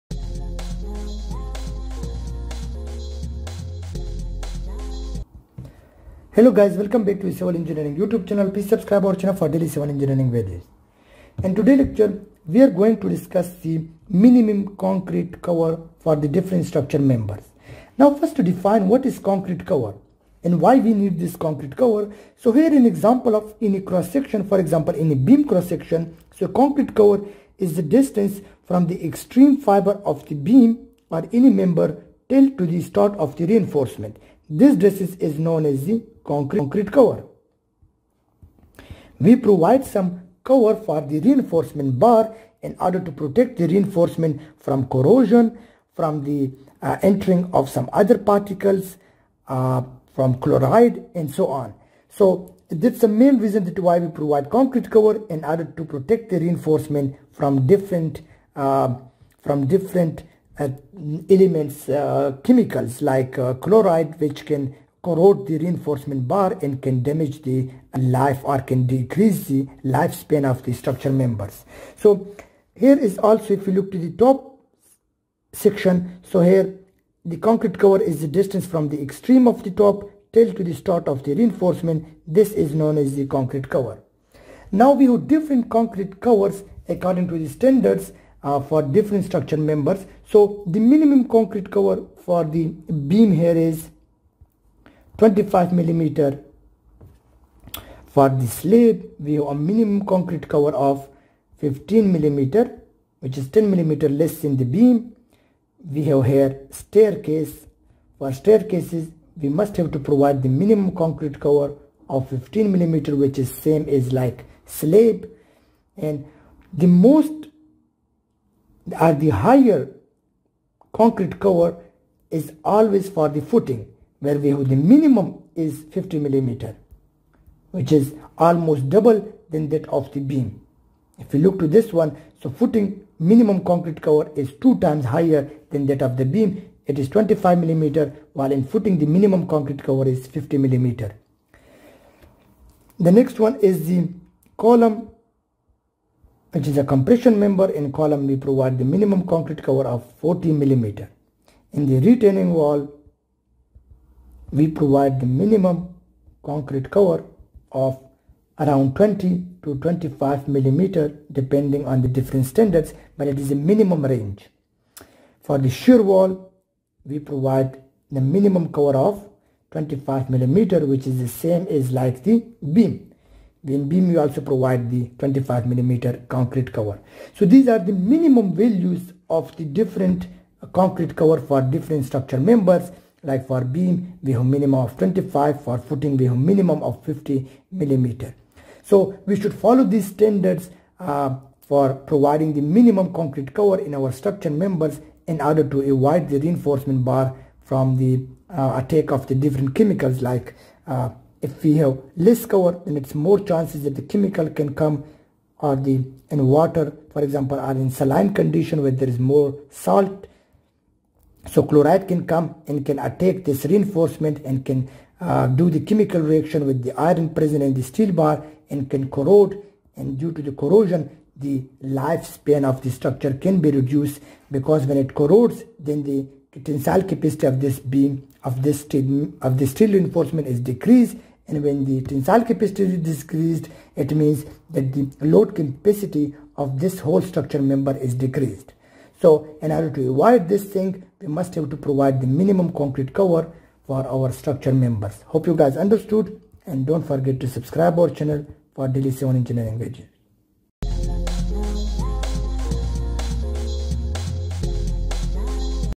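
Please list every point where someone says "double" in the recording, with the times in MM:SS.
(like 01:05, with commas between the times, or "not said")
02:08.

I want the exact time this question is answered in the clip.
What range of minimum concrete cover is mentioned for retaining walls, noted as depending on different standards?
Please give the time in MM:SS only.
02:38.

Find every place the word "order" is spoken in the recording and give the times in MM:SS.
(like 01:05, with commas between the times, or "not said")
00:42, 00:55, 03:15, 03:59.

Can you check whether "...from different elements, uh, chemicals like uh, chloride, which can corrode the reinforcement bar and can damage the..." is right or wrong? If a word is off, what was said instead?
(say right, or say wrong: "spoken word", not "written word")
right.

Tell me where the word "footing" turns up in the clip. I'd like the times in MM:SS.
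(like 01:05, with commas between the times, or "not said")
02:03, 02:12, 02:18, 03:05.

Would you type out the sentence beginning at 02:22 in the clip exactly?
The next one is the column which is a compression member in column we provide the minimum concrete cover of 40 millimeter.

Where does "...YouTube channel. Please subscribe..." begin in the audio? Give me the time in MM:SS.
00:07.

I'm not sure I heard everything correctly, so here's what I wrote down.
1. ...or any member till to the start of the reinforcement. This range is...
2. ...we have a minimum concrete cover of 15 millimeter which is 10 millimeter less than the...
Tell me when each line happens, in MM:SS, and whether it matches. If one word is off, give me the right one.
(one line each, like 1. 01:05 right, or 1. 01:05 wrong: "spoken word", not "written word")
1. 00:31 wrong: "dressage", not "range"
2. 01:39 right.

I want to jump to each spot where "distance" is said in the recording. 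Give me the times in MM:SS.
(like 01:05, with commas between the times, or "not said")
00:27, 01:18.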